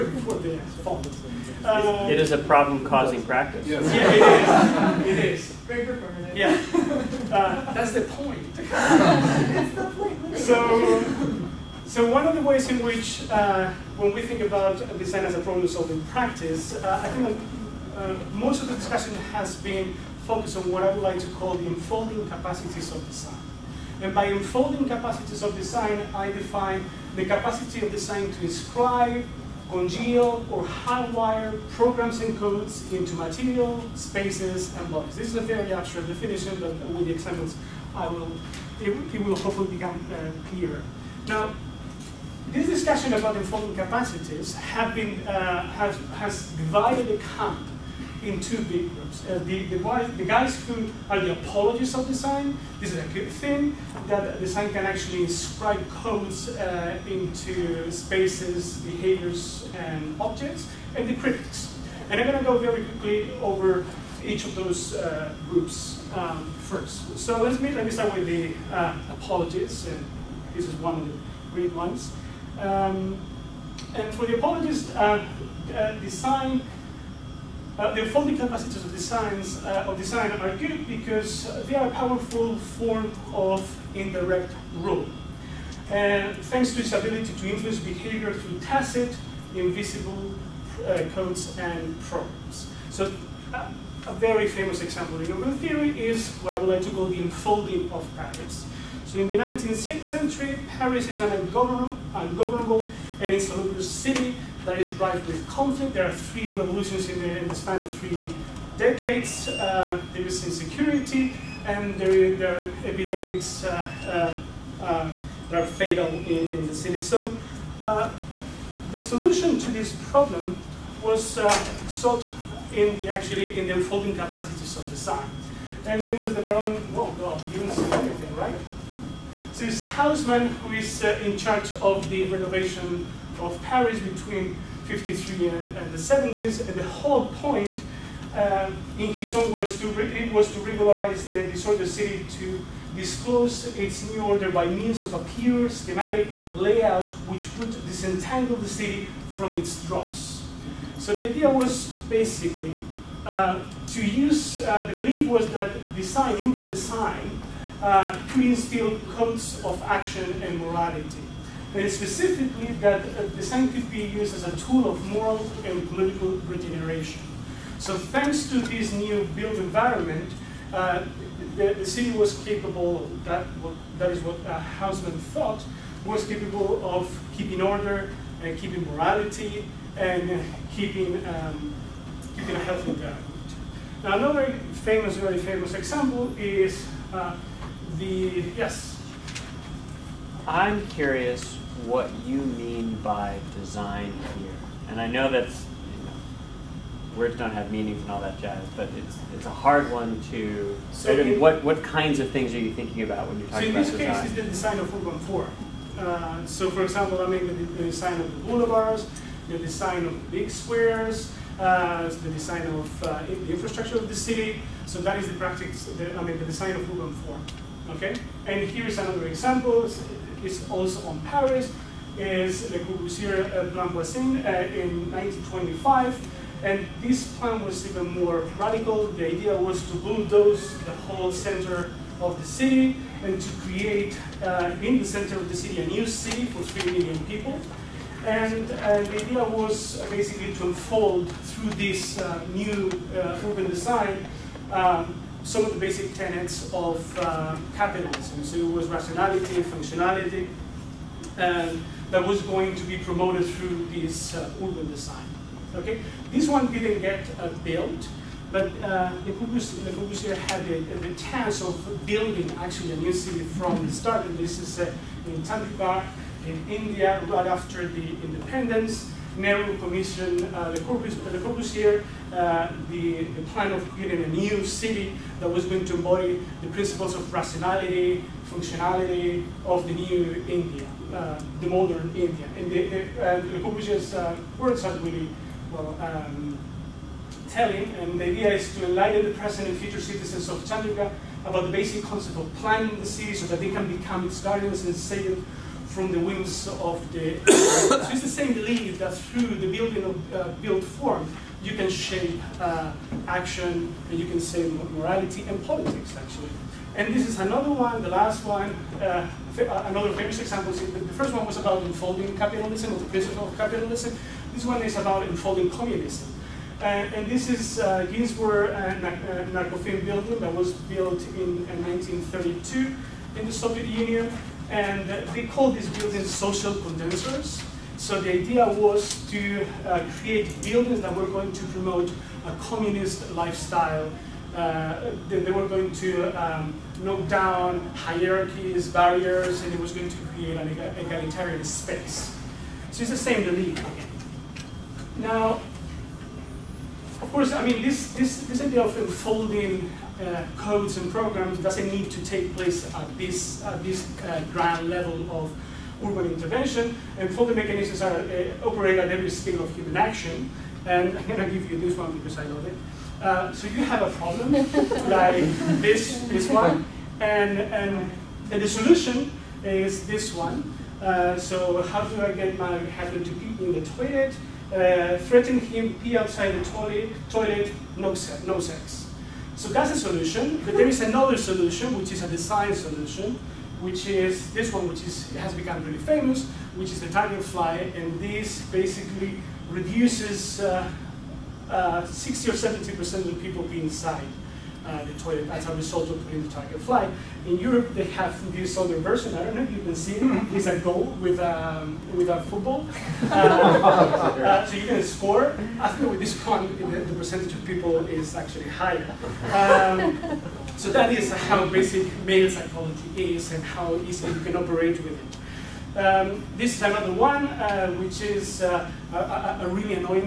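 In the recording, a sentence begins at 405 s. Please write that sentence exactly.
I think with this one, the, the percentage of people is actually higher.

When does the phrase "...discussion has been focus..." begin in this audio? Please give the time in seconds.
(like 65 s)
18 s.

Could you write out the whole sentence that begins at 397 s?
In Europe, they have this other version.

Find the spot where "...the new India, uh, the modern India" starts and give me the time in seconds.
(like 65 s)
279 s.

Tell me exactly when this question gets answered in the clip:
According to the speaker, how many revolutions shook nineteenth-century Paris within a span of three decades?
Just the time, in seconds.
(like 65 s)
106 s.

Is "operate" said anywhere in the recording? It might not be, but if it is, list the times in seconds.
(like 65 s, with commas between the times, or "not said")
358 s, 414 s.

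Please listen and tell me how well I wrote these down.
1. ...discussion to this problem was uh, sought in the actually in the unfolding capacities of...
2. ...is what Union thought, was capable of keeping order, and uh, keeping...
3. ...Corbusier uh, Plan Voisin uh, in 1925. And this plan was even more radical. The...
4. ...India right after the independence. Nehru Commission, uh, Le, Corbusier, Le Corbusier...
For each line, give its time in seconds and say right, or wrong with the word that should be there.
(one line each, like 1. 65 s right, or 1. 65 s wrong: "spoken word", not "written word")
1. 118 s wrong: "solution", not "discussion"
2. 174 s wrong: "Haussmann", not "Union"
3. 222 s right
4. 266 s right.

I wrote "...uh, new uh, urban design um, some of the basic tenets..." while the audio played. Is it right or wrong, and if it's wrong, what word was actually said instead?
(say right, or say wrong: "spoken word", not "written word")
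right.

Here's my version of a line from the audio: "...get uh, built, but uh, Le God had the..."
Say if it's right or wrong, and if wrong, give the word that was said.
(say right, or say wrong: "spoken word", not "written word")
wrong: "Corbusier", not "God".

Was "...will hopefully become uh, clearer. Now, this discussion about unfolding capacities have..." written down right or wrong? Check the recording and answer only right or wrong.
right.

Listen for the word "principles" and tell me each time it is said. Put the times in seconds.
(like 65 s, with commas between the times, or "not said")
276 s, 313 s.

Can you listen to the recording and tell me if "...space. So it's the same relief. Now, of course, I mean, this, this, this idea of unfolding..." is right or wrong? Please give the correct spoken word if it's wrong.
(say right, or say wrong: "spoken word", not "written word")
right.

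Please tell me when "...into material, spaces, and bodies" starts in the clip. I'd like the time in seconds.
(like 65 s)
32 s.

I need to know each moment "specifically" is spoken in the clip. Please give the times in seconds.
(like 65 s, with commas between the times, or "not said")
161 s.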